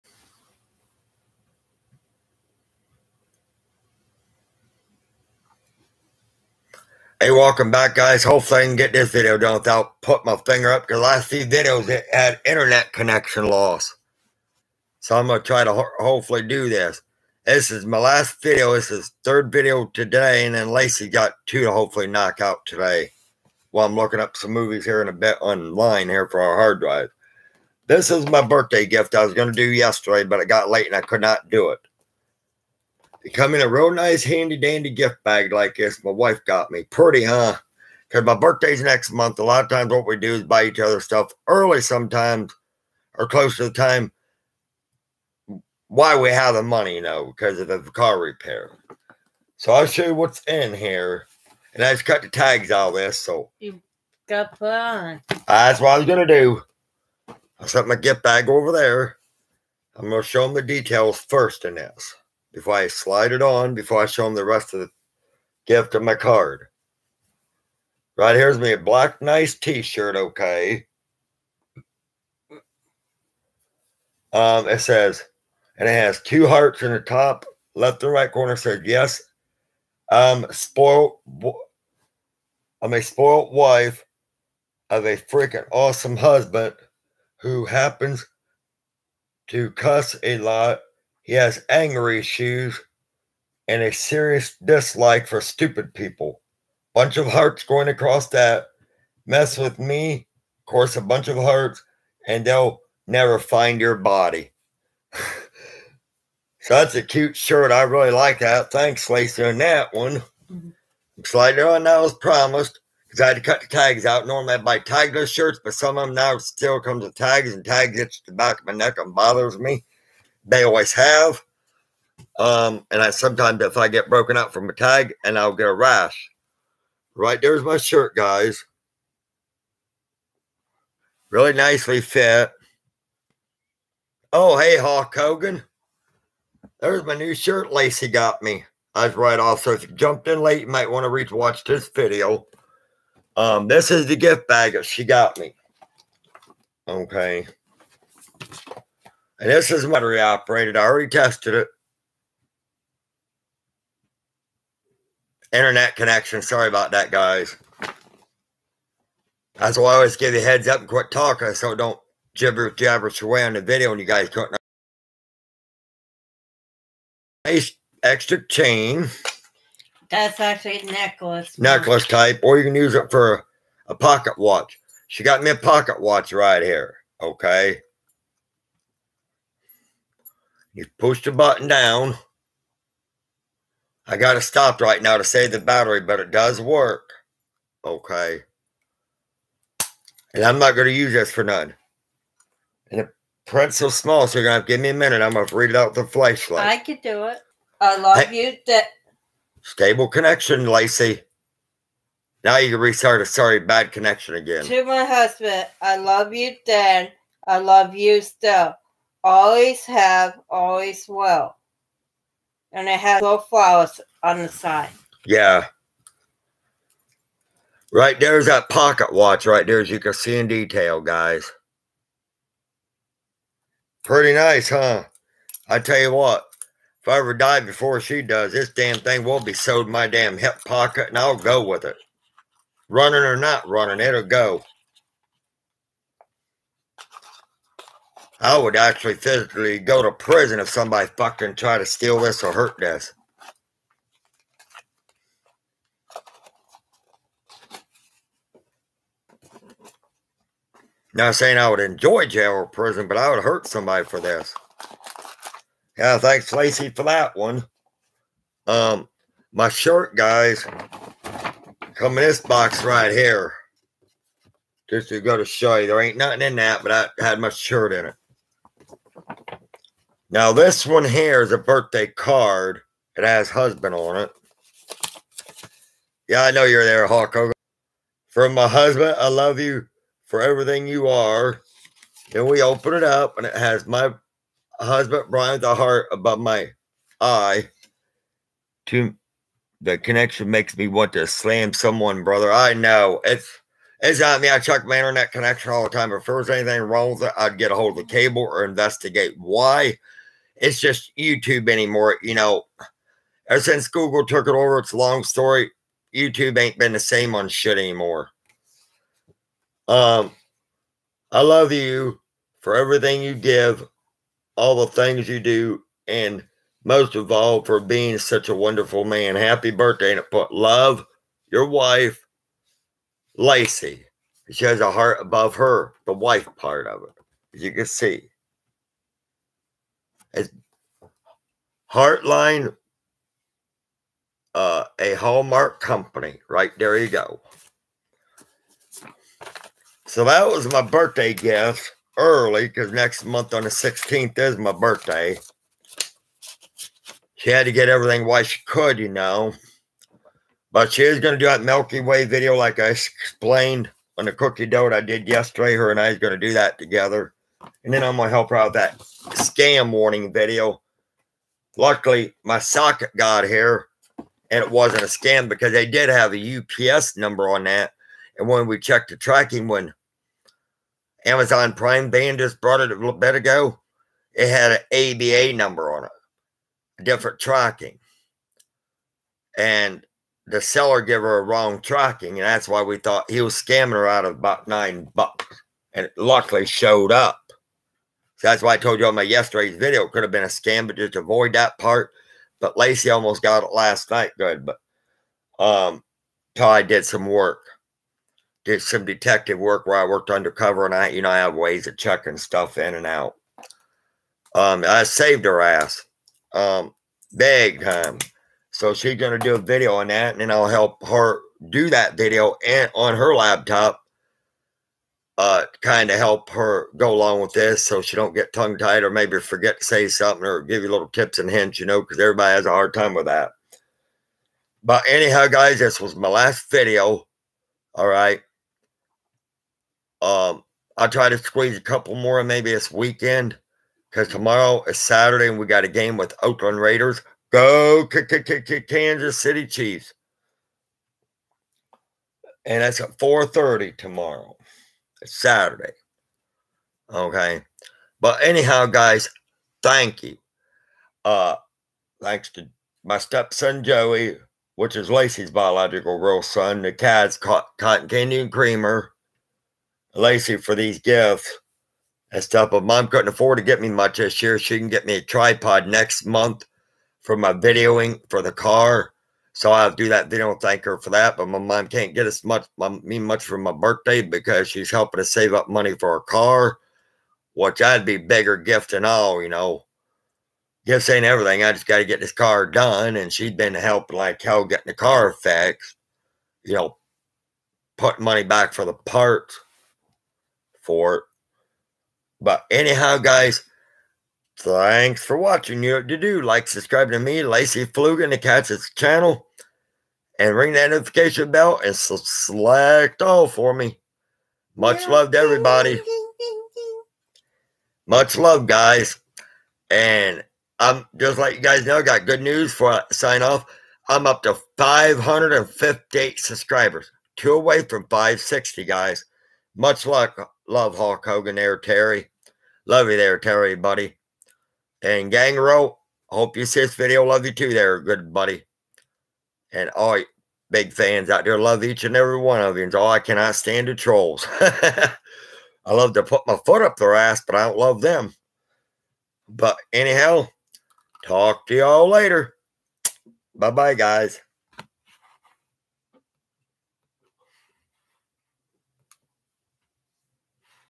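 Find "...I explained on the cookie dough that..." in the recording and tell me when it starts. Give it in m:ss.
5:52.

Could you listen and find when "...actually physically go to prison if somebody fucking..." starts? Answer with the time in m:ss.
3:58.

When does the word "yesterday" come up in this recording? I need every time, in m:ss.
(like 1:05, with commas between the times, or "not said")
0:29, 5:55, 6:29.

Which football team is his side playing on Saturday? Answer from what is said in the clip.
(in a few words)
Oakland Raiders.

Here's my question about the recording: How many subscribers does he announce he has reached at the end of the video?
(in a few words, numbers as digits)
558.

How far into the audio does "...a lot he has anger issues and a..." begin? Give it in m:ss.
1:30.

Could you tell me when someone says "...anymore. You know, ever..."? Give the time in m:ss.
5:01.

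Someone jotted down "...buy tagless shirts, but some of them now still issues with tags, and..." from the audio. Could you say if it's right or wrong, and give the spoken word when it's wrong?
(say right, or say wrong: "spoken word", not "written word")
wrong: "comes", not "issues".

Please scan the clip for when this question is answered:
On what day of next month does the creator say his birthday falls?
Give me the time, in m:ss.
5:43.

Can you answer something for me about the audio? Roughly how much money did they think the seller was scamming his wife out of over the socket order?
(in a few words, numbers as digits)
About 9 dollars.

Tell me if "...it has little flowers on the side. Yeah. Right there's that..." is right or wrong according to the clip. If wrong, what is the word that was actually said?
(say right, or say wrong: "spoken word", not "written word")
right.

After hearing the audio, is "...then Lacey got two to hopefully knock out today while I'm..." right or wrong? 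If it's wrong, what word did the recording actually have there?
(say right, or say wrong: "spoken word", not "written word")
right.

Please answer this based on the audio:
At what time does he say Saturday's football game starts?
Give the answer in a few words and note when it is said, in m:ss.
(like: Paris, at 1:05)
4:30, at 7:23.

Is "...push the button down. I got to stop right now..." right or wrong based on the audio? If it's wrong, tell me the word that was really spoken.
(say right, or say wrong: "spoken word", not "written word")
right.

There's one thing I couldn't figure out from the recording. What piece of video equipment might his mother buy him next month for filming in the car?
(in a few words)
Tripod.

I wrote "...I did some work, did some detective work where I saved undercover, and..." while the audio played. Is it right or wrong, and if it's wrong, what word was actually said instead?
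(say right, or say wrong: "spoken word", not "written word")
wrong: "worked", not "saved".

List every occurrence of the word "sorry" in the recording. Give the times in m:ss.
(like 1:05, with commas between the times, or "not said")
2:36, 3:23.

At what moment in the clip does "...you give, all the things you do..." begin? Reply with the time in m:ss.
5:13.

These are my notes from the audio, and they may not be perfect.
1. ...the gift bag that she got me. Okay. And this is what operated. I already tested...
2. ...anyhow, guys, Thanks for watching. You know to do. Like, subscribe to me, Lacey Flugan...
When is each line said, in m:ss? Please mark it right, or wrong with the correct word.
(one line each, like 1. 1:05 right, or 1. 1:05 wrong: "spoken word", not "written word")
1. 2:24 right
2. 8:12 right.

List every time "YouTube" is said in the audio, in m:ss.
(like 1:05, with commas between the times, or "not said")
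5:01, 5:06.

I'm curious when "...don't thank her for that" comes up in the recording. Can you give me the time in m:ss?
7:50.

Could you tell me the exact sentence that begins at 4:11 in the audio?
Not saying I would enjoy jail or prison, but I would hurt somebody for this.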